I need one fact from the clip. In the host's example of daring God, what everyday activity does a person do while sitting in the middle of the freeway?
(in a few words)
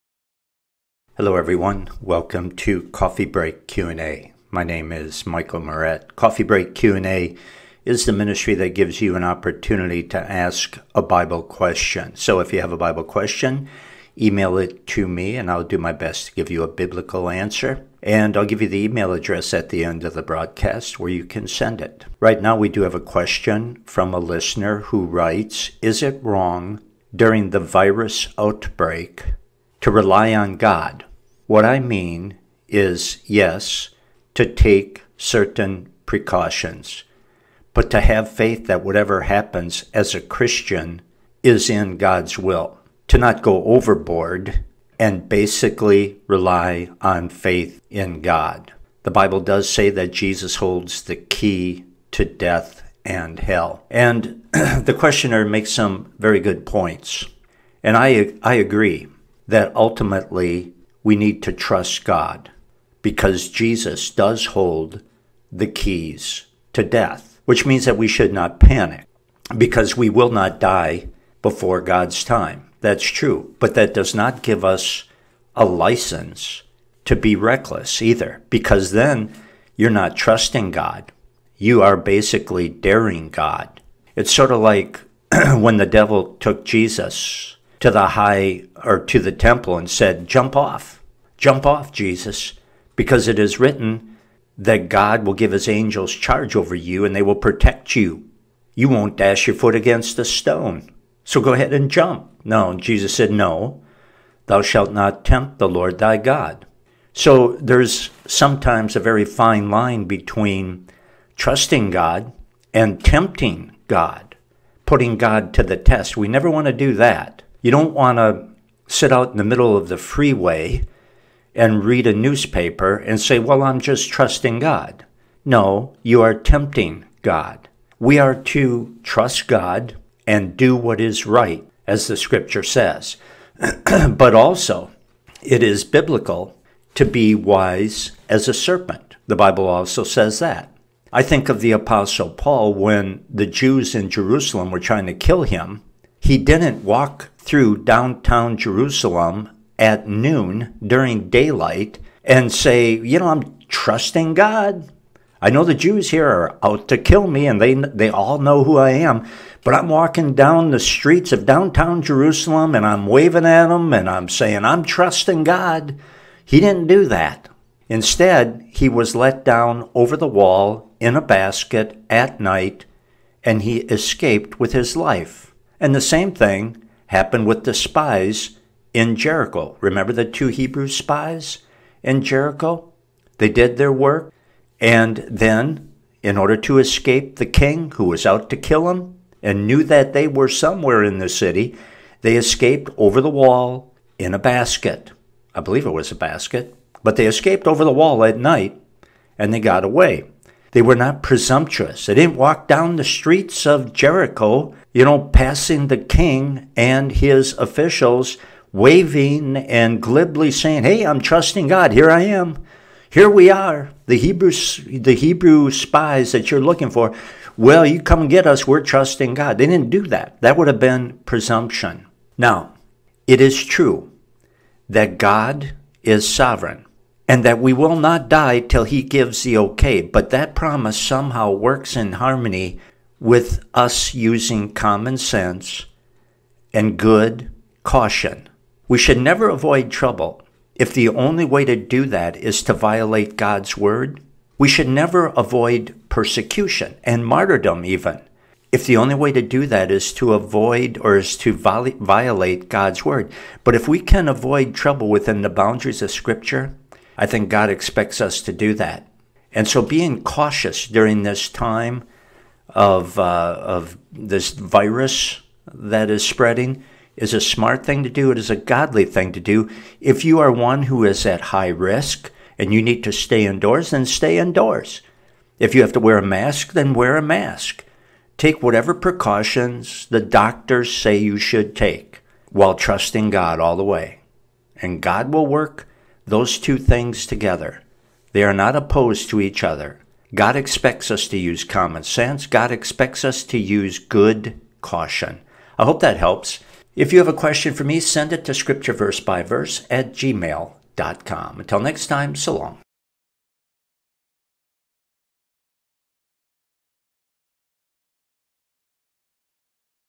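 read a newspaper.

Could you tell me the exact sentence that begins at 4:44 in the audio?
And God will work those two things together.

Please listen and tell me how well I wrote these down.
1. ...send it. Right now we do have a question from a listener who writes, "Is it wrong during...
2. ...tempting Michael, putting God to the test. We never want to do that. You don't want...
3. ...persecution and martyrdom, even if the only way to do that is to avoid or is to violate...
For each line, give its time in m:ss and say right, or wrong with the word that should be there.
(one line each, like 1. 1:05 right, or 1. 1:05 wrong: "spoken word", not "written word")
1. 0:21 right
2. 1:53 wrong: "God", not "Michael"
3. 4:06 right.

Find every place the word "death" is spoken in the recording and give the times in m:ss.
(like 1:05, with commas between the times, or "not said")
0:52, 1:06.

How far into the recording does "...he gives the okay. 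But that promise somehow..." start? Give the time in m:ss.
3:48.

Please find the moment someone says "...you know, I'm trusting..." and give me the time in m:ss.
2:32.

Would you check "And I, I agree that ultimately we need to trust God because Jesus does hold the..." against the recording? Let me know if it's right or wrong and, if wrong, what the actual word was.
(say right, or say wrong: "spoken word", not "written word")
right.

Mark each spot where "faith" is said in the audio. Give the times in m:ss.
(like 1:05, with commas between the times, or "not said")
0:38, 0:47.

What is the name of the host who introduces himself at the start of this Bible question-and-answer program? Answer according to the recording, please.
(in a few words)
Michael Meurett.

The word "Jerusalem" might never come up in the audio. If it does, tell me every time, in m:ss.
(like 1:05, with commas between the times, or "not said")
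2:24, 2:28, 2:42.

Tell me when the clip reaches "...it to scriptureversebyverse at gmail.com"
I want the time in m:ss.
4:58.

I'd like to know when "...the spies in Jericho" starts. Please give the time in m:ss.
2:57.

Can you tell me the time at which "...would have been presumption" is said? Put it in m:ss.
3:40.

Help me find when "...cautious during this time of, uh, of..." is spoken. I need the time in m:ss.
4:20.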